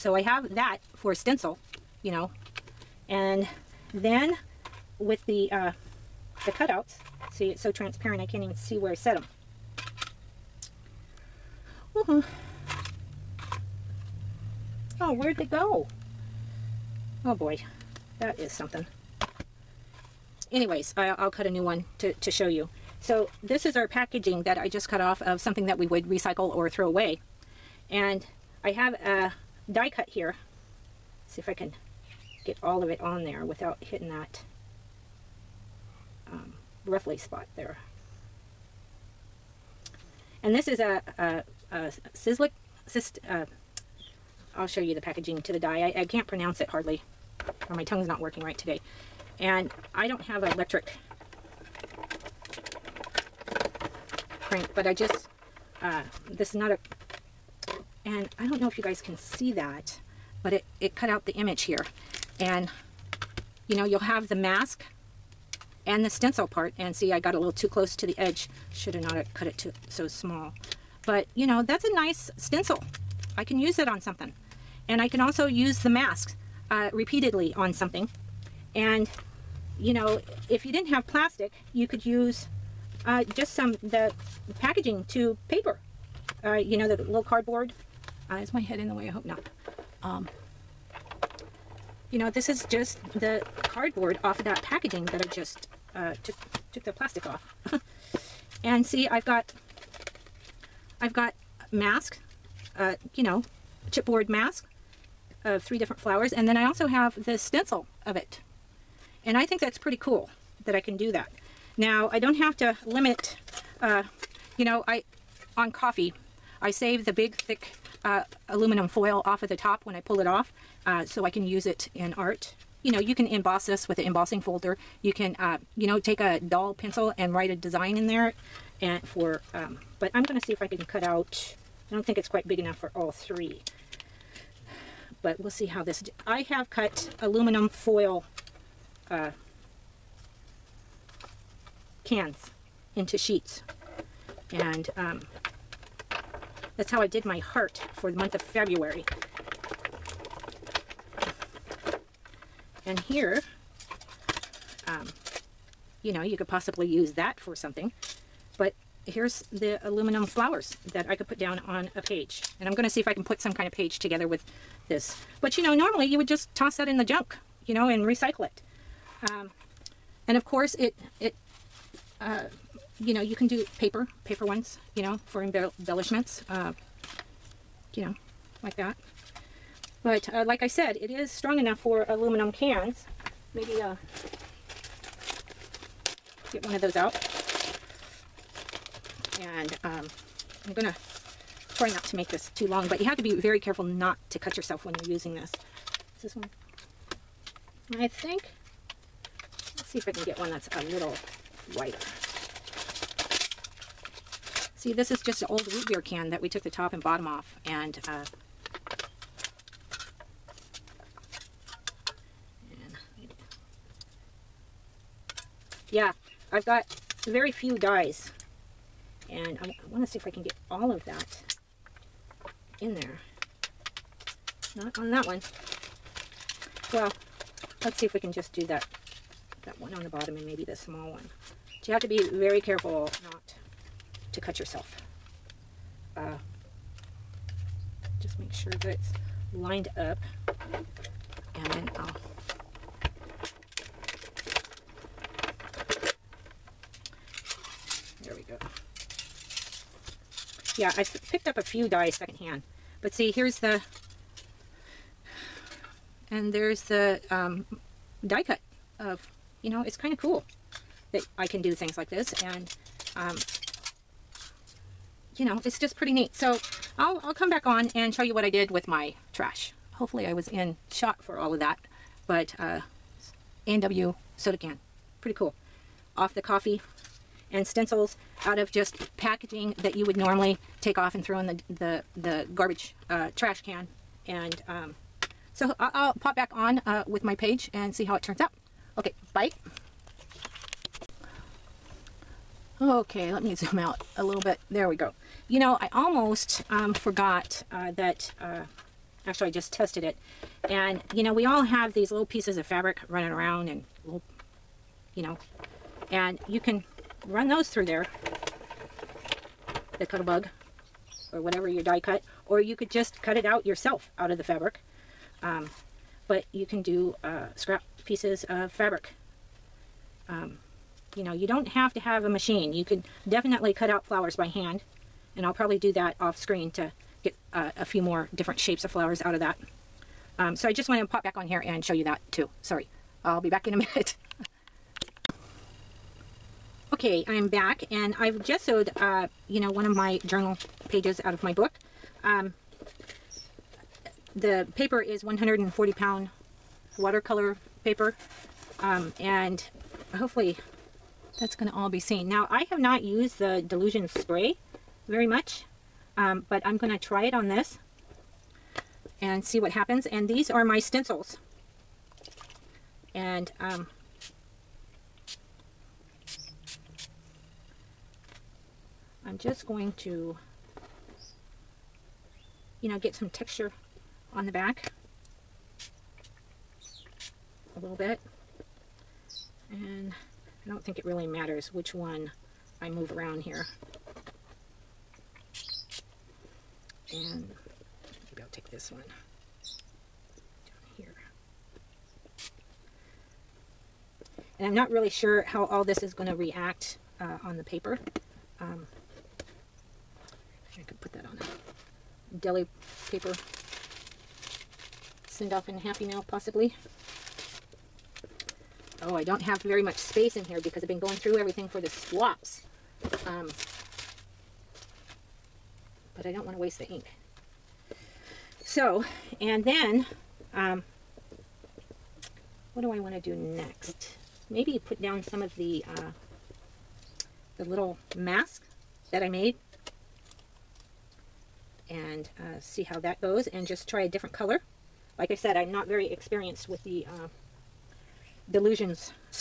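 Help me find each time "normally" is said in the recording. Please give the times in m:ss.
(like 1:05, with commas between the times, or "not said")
2:45, 4:40.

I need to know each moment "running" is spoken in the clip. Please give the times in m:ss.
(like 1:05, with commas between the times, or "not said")
5:03.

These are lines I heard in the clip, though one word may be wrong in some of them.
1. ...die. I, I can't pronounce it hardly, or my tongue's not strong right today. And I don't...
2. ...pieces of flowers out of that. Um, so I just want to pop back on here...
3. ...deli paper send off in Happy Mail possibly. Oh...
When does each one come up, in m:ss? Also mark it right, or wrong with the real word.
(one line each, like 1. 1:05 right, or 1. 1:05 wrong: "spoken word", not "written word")
1. 0:45 wrong: "working", not "strong"
2. 5:28 wrong: "shapes", not "pieces"
3. 6:42 right.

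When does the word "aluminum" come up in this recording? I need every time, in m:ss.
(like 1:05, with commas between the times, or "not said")
1:58, 2:17, 2:39, 3:02.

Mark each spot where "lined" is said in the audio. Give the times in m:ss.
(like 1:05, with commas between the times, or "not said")
3:59.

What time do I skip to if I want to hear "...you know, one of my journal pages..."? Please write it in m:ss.
5:39.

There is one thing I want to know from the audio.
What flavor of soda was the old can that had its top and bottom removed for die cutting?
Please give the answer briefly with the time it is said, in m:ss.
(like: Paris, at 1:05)
root beer, at 3:25.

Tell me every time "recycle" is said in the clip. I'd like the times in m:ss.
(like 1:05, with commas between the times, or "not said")
0:26, 2:48.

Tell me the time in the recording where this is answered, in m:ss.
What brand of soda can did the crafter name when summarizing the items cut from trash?
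4:33.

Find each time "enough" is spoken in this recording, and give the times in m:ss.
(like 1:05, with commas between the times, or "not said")
2:12, 3:01.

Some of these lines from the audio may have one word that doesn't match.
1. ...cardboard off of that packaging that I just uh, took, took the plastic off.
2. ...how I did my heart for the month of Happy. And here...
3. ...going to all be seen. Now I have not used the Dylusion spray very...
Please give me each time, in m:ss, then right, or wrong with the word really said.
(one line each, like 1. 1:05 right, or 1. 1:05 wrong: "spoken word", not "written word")
1. 1:33 right
2. 2:26 wrong: "February", not "Happy"
3. 5:51 right.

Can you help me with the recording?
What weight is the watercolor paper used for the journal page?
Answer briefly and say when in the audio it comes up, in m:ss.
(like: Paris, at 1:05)
140 pound, at 5:45.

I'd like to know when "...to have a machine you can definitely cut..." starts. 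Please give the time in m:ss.
5:21.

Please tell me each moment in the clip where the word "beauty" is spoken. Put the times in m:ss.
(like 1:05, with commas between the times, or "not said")
not said.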